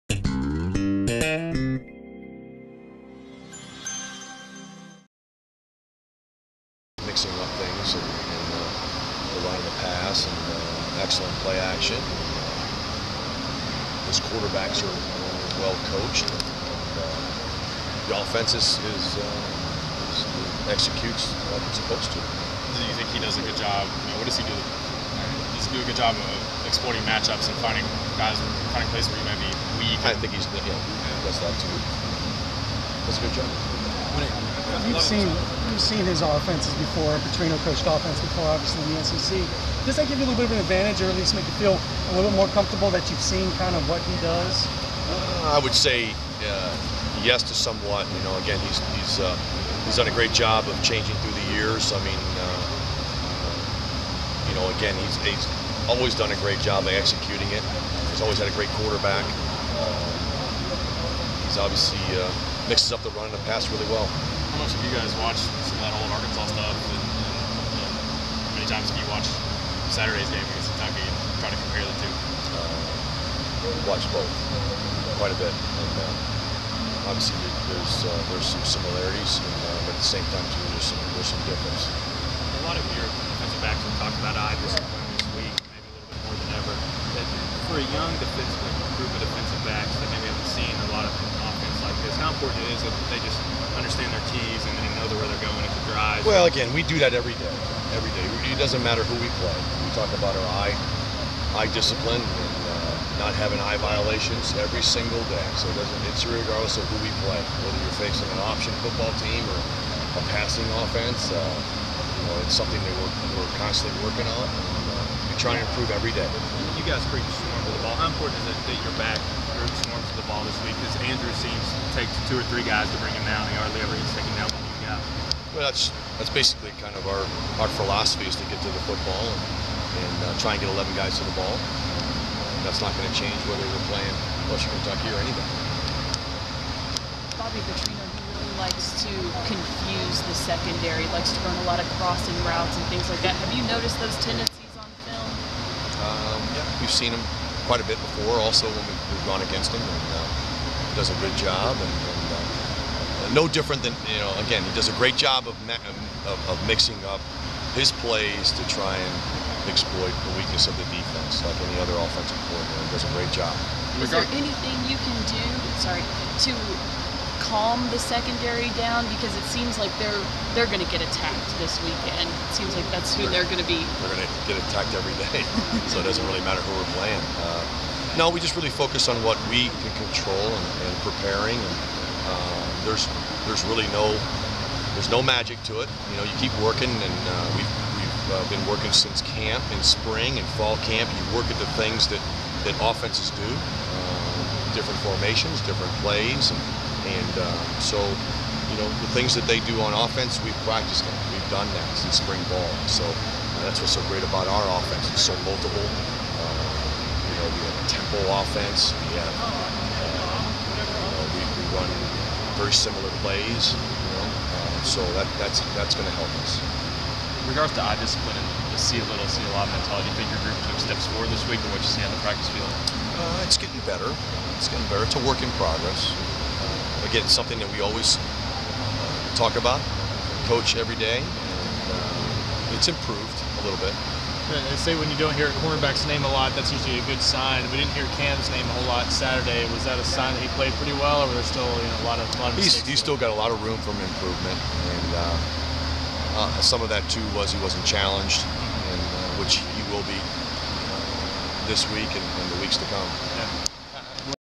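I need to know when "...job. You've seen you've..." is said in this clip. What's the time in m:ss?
0:33.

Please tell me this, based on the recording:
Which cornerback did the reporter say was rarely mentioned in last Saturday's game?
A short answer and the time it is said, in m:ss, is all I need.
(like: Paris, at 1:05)
Cam, at 3:58.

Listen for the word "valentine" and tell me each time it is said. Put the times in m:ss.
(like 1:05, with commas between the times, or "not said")
not said.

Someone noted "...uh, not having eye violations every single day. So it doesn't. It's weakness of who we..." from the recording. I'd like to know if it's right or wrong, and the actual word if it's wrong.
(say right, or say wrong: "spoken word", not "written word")
wrong: "regardless", not "weakness".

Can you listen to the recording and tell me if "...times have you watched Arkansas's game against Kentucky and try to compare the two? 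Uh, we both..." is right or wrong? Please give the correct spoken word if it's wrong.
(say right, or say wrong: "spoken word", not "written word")
wrong: "Saturday", not "Arkansas".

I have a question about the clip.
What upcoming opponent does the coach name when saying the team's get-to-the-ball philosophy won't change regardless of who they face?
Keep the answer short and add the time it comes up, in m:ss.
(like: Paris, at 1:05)
Western Kentucky, at 2:14.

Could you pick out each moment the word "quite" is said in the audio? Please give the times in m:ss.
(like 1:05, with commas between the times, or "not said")
1:15, 2:27.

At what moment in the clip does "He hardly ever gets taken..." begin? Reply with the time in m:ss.
2:03.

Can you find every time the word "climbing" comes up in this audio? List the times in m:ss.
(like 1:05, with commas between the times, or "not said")
not said.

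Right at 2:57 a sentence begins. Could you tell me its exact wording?
Uh, no, we just really focus on what we can control and, and preparing.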